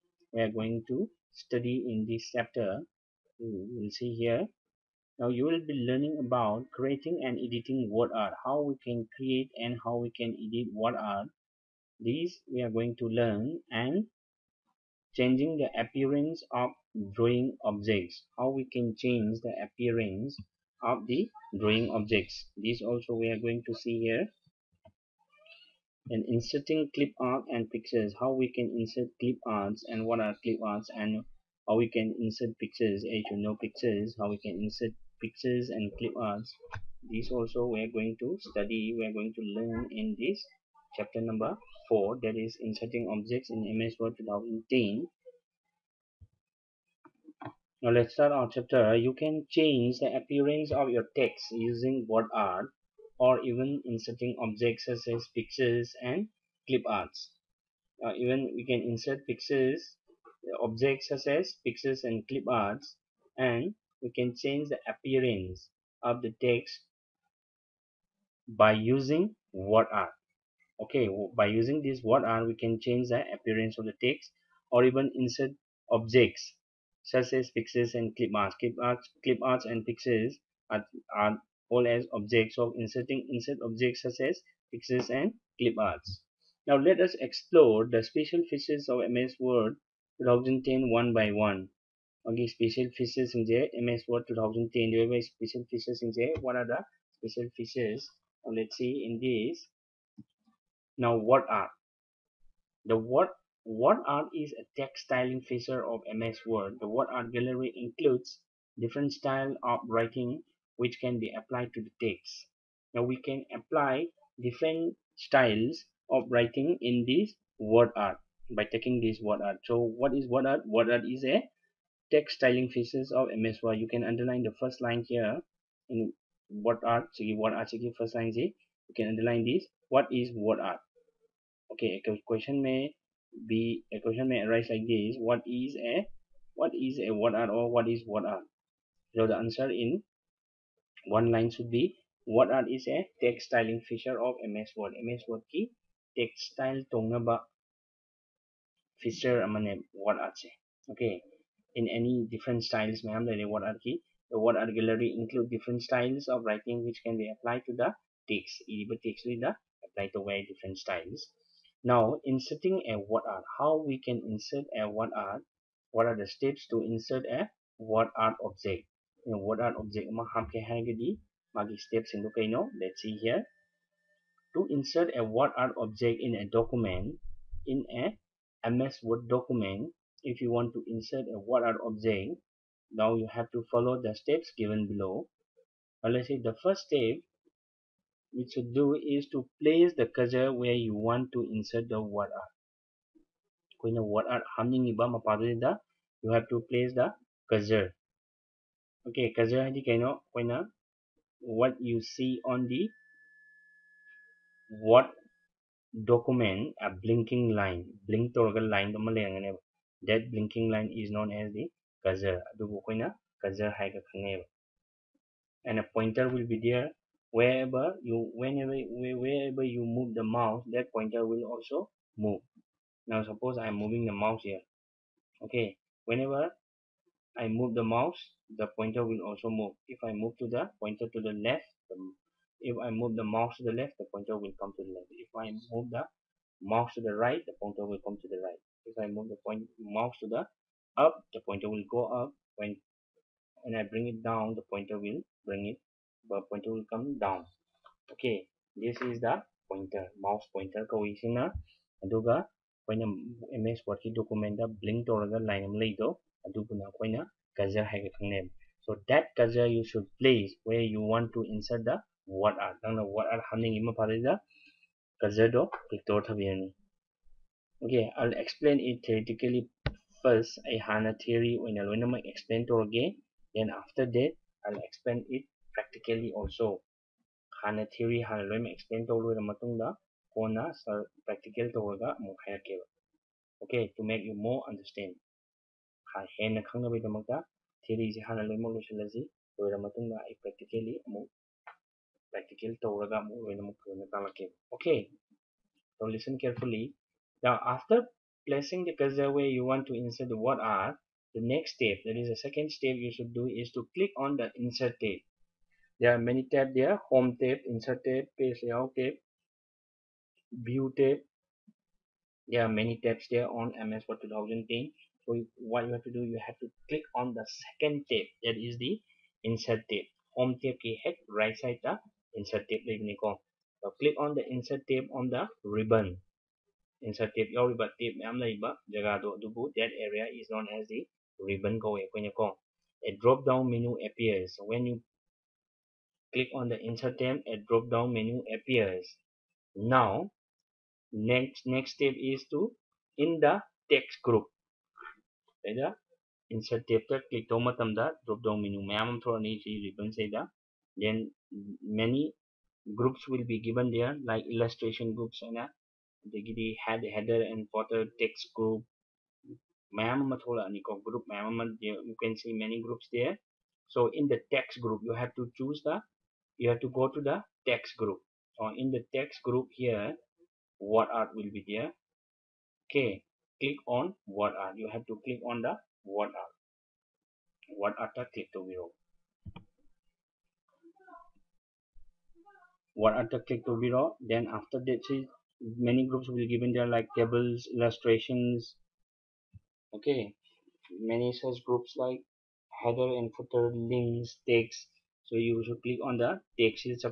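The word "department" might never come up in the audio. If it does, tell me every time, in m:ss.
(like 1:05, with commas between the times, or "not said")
not said.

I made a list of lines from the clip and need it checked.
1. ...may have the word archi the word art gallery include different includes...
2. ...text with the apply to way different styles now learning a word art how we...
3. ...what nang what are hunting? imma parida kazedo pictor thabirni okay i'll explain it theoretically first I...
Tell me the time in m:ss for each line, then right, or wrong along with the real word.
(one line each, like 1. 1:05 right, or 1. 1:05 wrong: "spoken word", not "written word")
1. 2:33 wrong: "styles", not "includes"
2. 2:39 wrong: "inserting", not "learning"
3. 4:22 right.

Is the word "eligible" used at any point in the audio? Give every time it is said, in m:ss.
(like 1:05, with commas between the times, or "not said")
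not said.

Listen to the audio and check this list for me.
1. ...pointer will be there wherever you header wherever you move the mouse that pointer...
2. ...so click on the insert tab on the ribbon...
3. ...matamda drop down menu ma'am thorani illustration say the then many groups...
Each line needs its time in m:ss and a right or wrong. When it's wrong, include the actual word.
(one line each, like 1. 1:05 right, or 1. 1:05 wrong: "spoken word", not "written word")
1. 3:35 wrong: "whenever", not "header"
2. 5:23 right
3. 5:47 wrong: "ribbon", not "illustration".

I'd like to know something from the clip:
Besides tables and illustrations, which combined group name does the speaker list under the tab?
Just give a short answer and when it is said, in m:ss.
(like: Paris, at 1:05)
header and footer, at 6:32.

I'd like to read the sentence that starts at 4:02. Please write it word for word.
When when I bring it down, the pointer will bring it, the pointer will come down.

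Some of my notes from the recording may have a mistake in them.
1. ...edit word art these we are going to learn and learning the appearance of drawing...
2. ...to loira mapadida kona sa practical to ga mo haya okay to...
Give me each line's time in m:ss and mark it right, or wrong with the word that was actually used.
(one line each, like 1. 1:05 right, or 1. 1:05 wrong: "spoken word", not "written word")
1. 0:10 wrong: "changing", not "learning"
2. 4:39 wrong: "matungda", not "mapadida".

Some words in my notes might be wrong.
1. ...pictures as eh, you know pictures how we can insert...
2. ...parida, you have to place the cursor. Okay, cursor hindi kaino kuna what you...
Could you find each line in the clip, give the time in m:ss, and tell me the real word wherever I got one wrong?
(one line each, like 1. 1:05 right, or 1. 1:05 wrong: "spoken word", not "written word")
1. 0:32 right
2. 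3:15 wrong: "mapadida", not "parida".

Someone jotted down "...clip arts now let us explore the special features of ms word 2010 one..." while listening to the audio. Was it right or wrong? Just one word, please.
right.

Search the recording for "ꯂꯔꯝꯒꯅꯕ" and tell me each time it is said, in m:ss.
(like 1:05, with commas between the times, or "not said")
3:29.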